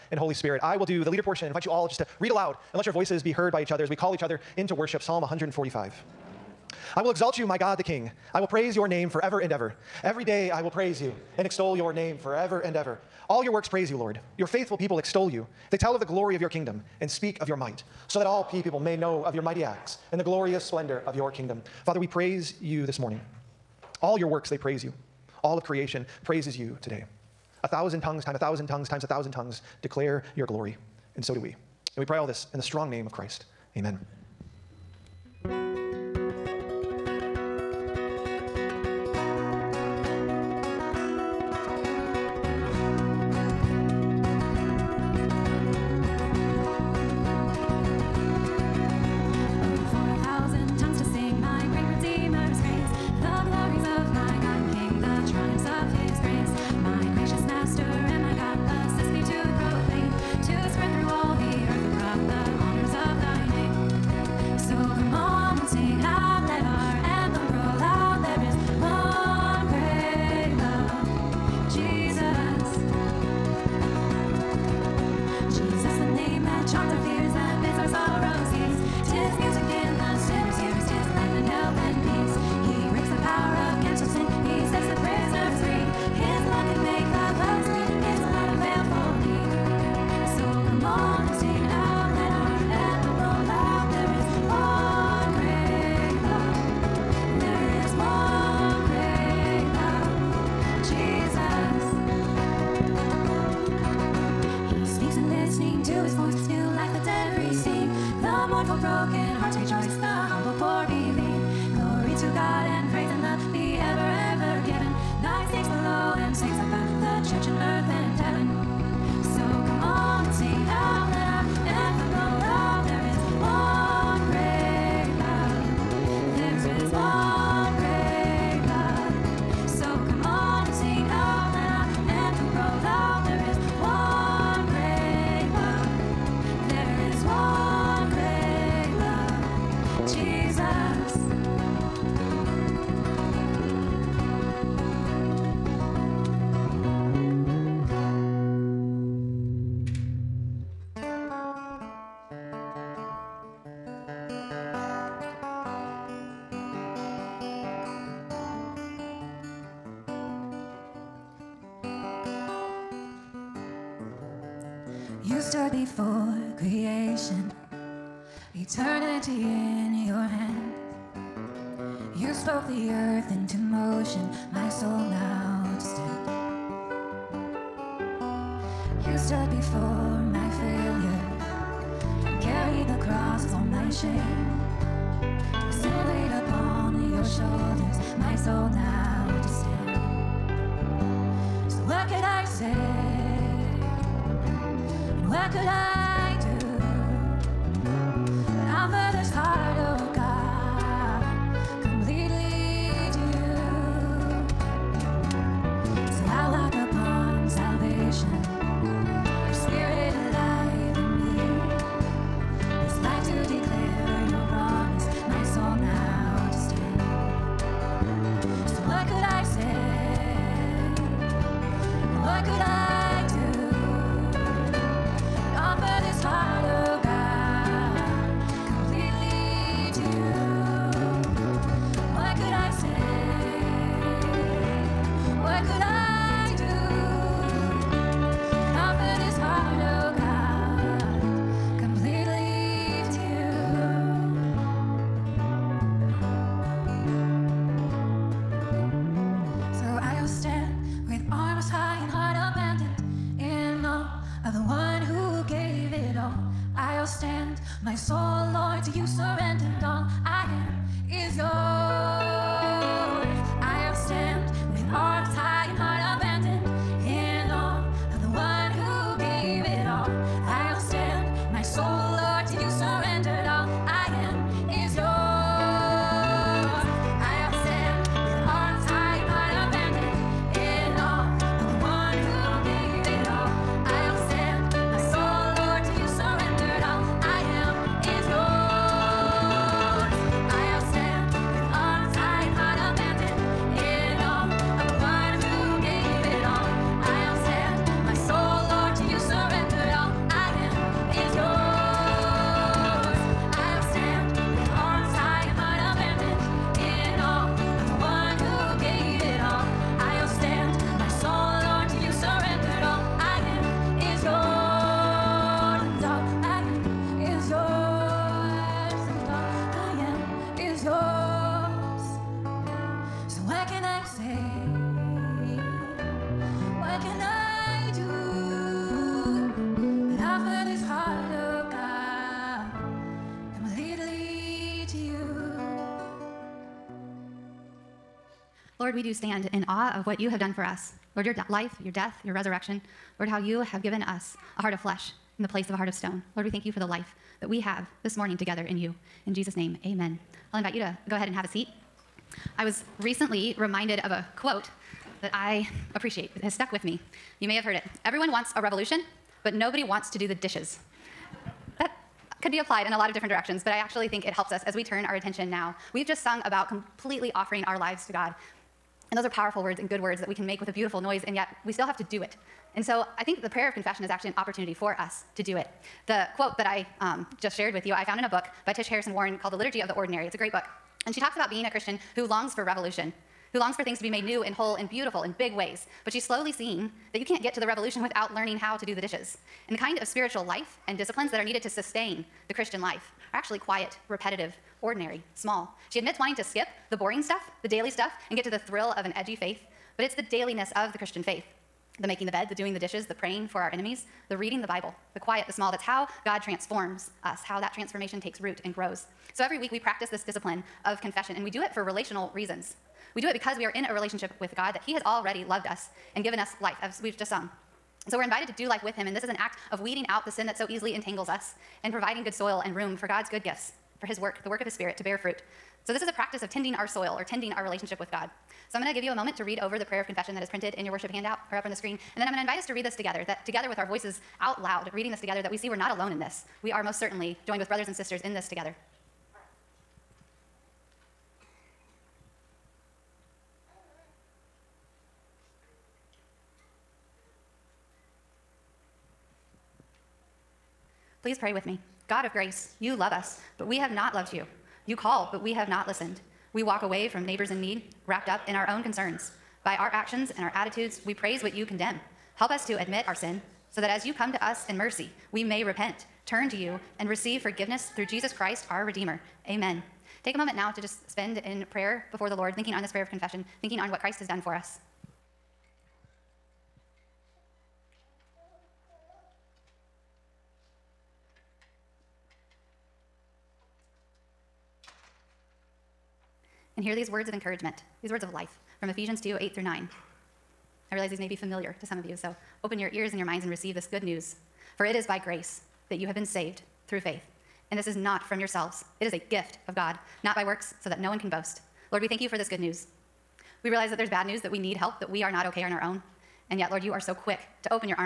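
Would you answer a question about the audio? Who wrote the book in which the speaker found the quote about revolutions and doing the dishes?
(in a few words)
Tish Harrison Warren.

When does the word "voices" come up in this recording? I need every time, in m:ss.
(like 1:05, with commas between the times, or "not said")
0:02, 7:13.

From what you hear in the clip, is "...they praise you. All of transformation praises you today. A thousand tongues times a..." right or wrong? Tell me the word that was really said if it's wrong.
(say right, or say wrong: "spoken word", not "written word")
wrong: "creation", not "transformation".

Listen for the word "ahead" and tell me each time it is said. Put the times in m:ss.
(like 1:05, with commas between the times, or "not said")
5:51.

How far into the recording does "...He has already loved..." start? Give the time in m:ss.
6:54.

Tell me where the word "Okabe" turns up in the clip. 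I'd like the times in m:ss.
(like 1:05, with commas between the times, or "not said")
not said.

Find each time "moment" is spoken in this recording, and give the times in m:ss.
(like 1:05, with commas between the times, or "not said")
7:09, 7:50.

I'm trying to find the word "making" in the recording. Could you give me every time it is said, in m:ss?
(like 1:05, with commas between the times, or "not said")
6:42.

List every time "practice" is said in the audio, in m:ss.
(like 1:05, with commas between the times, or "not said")
6:49, 7:06.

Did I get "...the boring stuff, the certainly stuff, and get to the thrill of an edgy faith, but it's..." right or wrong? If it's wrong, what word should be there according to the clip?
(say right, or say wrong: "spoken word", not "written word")
wrong: "daily", not "certainly".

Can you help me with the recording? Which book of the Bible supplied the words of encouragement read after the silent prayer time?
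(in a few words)
Ephesians.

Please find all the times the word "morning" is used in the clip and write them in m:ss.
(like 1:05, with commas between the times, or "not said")
0:22, 5:48.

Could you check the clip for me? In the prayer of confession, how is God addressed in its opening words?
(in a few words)
God of grace.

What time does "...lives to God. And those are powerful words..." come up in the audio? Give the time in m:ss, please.
6:07.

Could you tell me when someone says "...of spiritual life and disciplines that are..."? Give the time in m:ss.
6:30.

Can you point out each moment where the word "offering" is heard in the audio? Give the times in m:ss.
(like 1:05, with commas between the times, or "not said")
6:07.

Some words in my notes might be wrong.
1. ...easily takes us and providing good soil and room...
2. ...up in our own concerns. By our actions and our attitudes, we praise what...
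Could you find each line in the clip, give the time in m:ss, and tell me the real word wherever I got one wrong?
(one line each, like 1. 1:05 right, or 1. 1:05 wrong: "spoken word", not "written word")
1. 7:00 wrong: "entangles", not "takes"
2. 7:38 right.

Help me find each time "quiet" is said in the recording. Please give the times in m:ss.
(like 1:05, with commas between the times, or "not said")
6:33, 6:45.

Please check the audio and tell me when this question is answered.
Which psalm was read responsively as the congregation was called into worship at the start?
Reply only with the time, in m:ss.
0:05.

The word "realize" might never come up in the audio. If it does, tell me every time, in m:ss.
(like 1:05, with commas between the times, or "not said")
8:10, 8:23.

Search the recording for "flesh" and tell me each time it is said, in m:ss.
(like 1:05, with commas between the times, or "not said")
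5:44.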